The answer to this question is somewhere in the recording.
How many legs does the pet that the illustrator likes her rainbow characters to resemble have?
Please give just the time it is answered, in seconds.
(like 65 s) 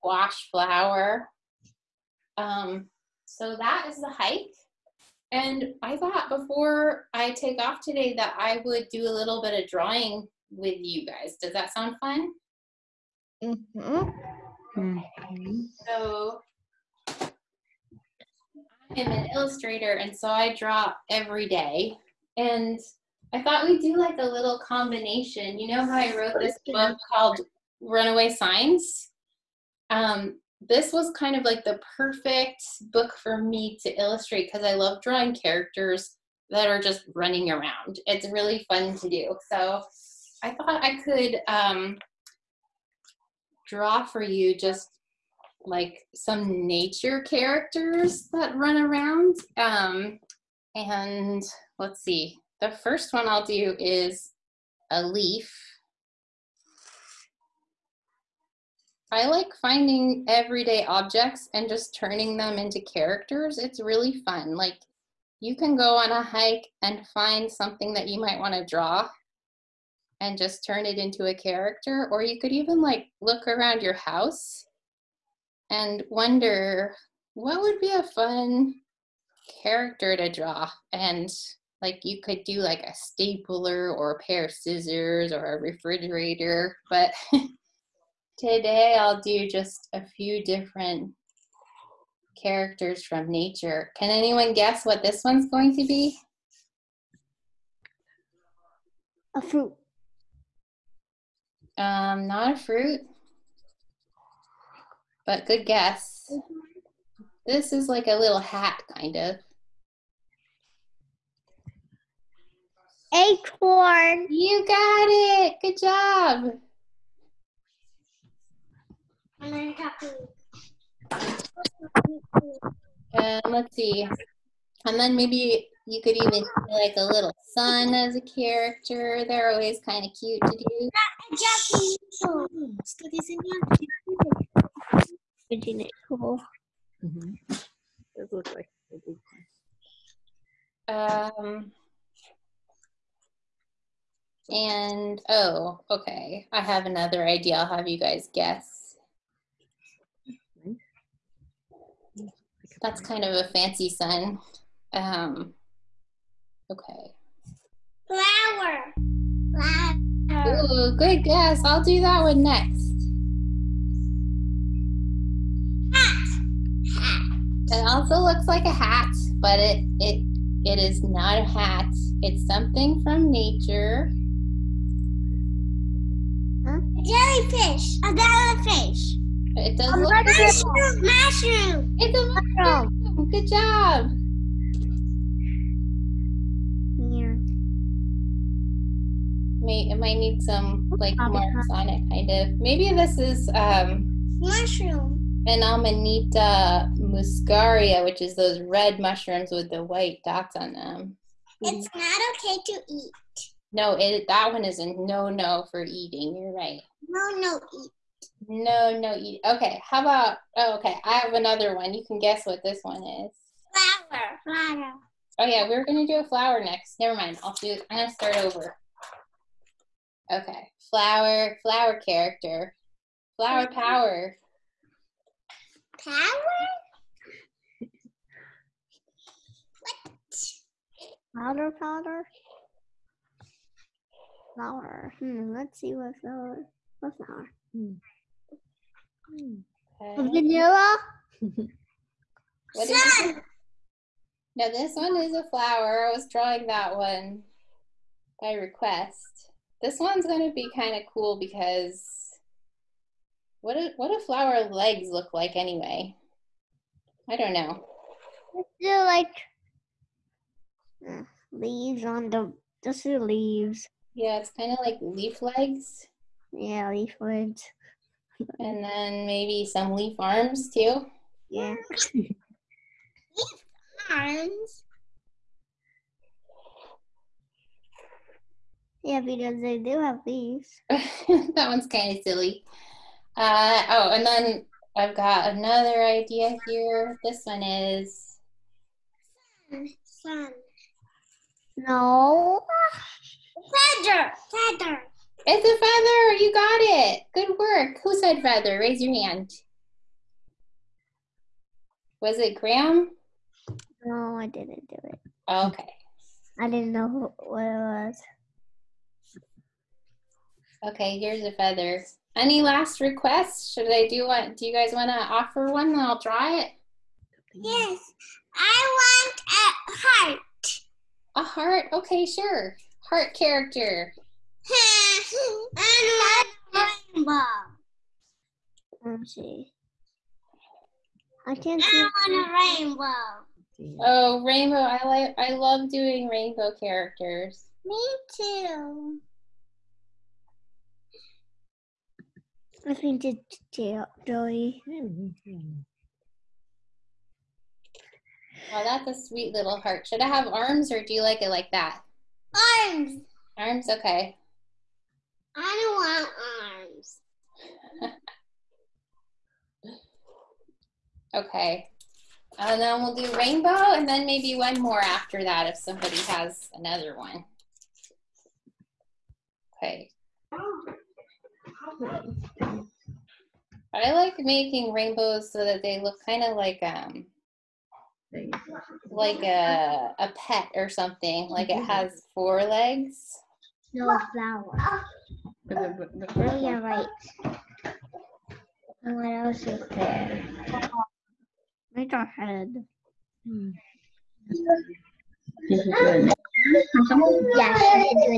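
382 s.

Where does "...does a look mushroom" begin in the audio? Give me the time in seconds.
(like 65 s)
179 s.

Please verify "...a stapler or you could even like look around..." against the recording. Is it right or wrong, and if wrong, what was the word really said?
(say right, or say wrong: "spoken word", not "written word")
wrong: "character", not "stapler".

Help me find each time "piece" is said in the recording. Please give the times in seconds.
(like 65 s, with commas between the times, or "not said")
not said.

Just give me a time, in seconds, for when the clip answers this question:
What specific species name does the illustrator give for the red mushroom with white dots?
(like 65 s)
195 s.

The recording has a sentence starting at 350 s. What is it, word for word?
Should I have arms or do you like it like that?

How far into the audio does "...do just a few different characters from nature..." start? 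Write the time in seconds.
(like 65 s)
89 s.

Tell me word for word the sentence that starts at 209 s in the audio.
Okay, how about oh okay, I have another one.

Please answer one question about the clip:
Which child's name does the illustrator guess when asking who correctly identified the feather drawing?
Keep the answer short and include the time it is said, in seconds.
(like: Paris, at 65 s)
Graham, at 302 s.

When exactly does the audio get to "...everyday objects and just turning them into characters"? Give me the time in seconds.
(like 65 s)
60 s.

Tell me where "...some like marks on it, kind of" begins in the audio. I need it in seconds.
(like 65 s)
190 s.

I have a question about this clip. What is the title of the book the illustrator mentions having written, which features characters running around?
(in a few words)
Runaway Signs.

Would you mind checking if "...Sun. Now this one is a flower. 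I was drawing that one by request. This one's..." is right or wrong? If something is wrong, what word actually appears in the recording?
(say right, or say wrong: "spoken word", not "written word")
right.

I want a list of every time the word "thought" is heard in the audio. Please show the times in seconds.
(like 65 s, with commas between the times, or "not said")
5 s, 23 s, 40 s.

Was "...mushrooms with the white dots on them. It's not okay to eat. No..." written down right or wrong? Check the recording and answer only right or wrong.
right.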